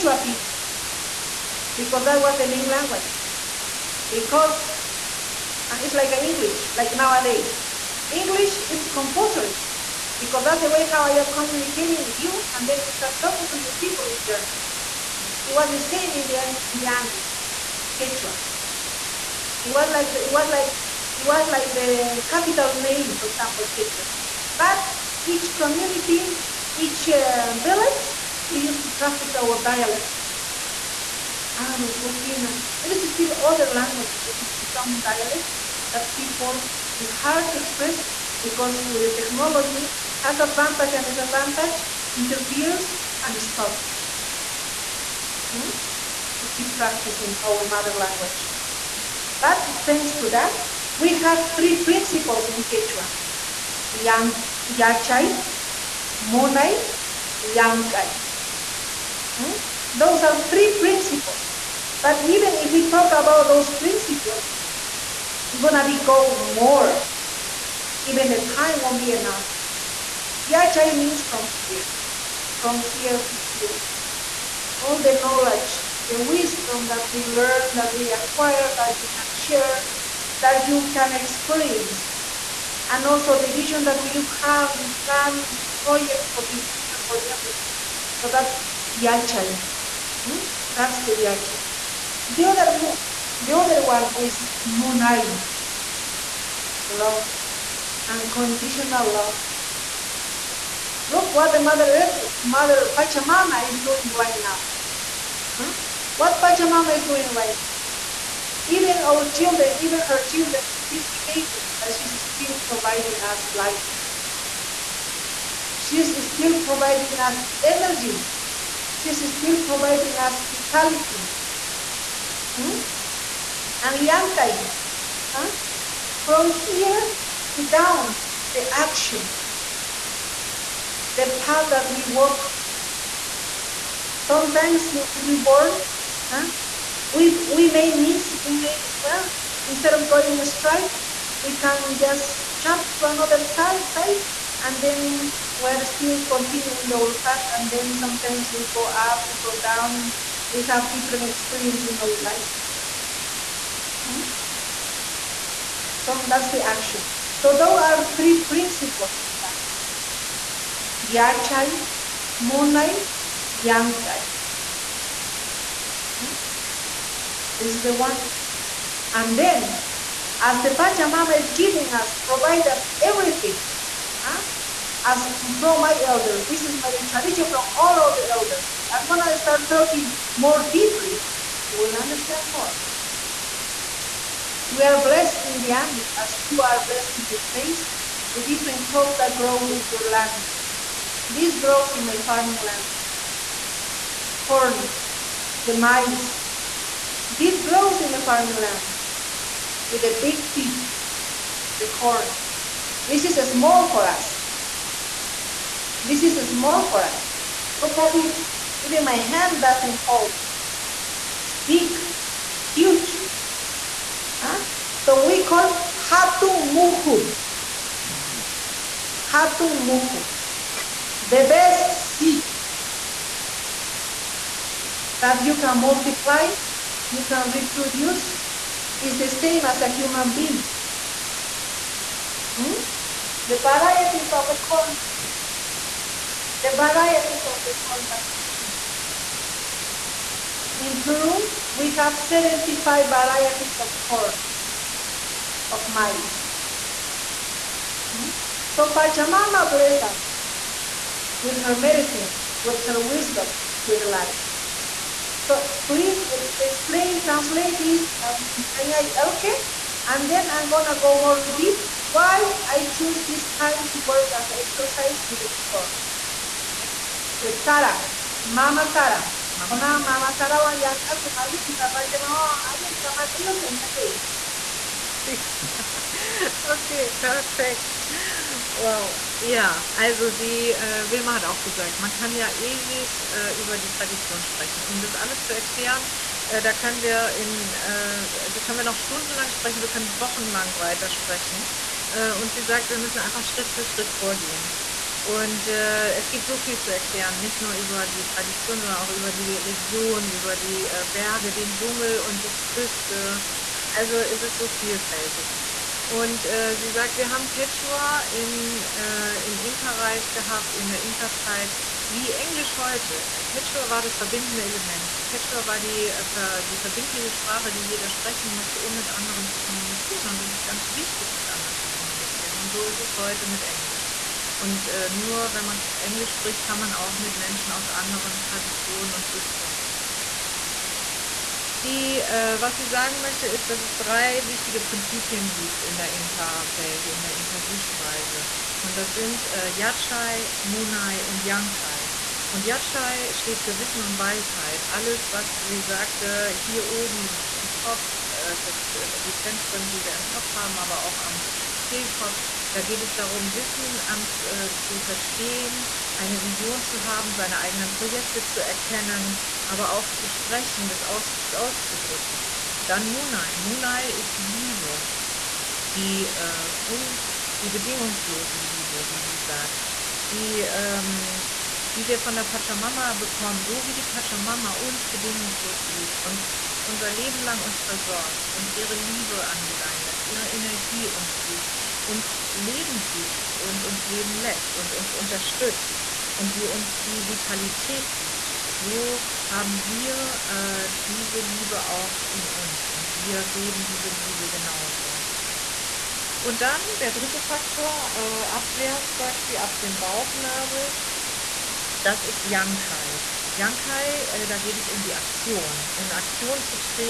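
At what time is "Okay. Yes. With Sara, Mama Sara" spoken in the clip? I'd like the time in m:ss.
4:26.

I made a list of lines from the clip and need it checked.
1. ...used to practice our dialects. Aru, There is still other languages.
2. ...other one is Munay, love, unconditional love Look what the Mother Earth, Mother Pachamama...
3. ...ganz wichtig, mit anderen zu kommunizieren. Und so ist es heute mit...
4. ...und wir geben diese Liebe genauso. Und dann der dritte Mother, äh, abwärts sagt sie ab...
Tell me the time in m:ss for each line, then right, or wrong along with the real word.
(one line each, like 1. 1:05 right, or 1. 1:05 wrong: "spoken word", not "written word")
1. 0:28 right
2. 1:33 right
3. 5:20 right
4. 6:32 wrong: "Faktor", not "Mother".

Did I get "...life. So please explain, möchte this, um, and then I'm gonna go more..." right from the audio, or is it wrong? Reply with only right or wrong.
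wrong.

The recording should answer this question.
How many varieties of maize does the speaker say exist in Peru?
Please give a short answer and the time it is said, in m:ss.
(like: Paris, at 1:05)
75, at 4:02.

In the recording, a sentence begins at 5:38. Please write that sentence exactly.
Und das sind äh, Yatshai, Munai und Yankai.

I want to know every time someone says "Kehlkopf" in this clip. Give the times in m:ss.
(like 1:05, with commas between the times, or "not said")
5:51.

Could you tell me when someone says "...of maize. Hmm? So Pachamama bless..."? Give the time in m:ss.
4:05.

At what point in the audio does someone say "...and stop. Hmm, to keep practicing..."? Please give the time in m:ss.
0:43.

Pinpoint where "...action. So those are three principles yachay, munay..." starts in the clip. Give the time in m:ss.
2:36.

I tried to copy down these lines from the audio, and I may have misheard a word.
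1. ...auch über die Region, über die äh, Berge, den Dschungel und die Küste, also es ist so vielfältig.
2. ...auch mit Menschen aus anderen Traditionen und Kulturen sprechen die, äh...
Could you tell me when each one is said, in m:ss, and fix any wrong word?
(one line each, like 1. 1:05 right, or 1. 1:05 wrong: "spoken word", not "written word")
1. 4:58 right
2. 5:26 right.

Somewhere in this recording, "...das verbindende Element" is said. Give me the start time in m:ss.
5:14.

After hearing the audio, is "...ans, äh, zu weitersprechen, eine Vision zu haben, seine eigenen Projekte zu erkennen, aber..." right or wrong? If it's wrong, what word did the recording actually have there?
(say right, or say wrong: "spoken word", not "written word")
wrong: "verstehen", not "weitersprechen".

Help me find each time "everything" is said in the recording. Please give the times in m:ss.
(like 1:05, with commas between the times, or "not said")
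1:27, 2:53.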